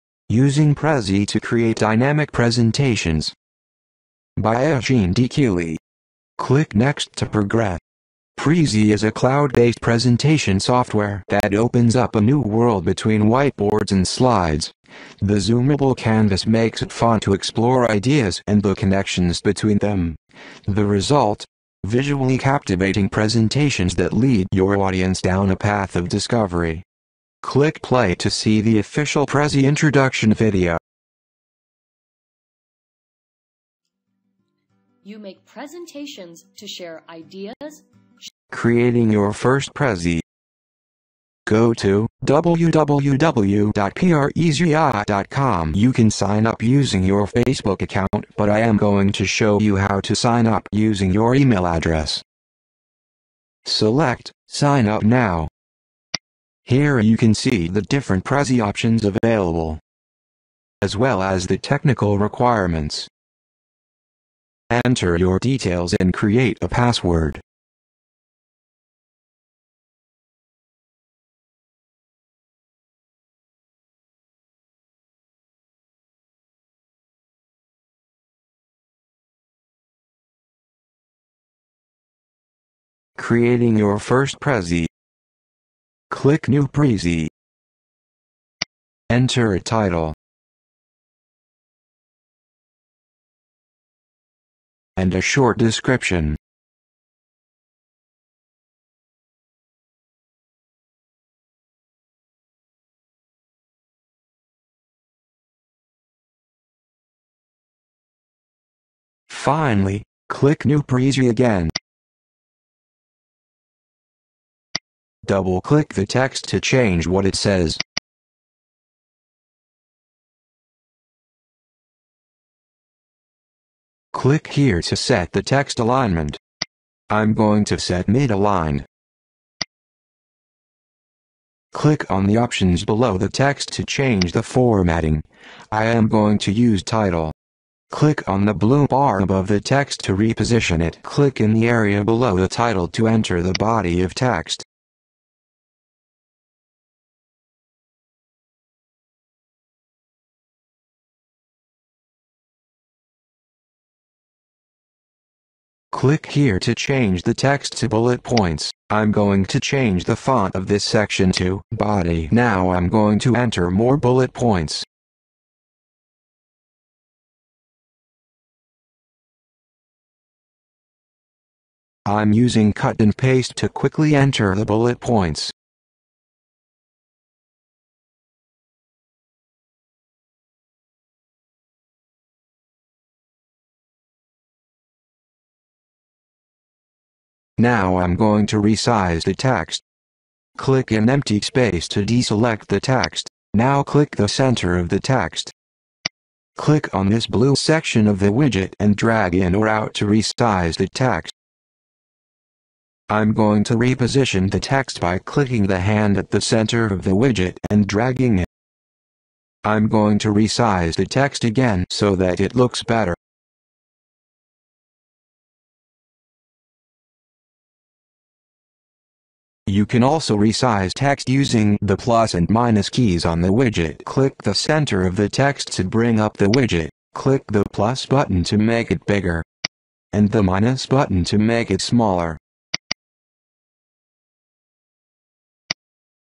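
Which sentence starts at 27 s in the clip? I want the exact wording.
Click play to see the official Prezi introduction video.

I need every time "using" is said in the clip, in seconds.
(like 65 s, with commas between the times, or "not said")
0 s, 46 s, 50 s, 172 s, 221 s.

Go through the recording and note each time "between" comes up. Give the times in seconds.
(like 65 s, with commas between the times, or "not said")
12 s, 19 s.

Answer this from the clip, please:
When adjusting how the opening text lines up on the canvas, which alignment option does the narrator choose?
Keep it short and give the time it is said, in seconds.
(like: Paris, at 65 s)
mid-align, at 128 s.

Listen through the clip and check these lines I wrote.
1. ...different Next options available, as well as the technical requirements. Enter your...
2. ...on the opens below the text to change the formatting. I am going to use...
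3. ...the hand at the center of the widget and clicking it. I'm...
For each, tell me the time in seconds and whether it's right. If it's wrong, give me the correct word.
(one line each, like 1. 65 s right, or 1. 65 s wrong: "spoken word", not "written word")
1. 57 s wrong: "Prezi", not "Next"
2. 132 s wrong: "options", not "opens"
3. 205 s wrong: "dragging", not "clicking".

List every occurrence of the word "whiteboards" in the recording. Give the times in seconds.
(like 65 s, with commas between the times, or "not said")
13 s.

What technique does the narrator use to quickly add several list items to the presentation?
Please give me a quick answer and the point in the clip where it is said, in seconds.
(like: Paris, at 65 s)
cut and paste, at 172 s.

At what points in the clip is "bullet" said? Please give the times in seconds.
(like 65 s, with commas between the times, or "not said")
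157 s, 163 s, 174 s.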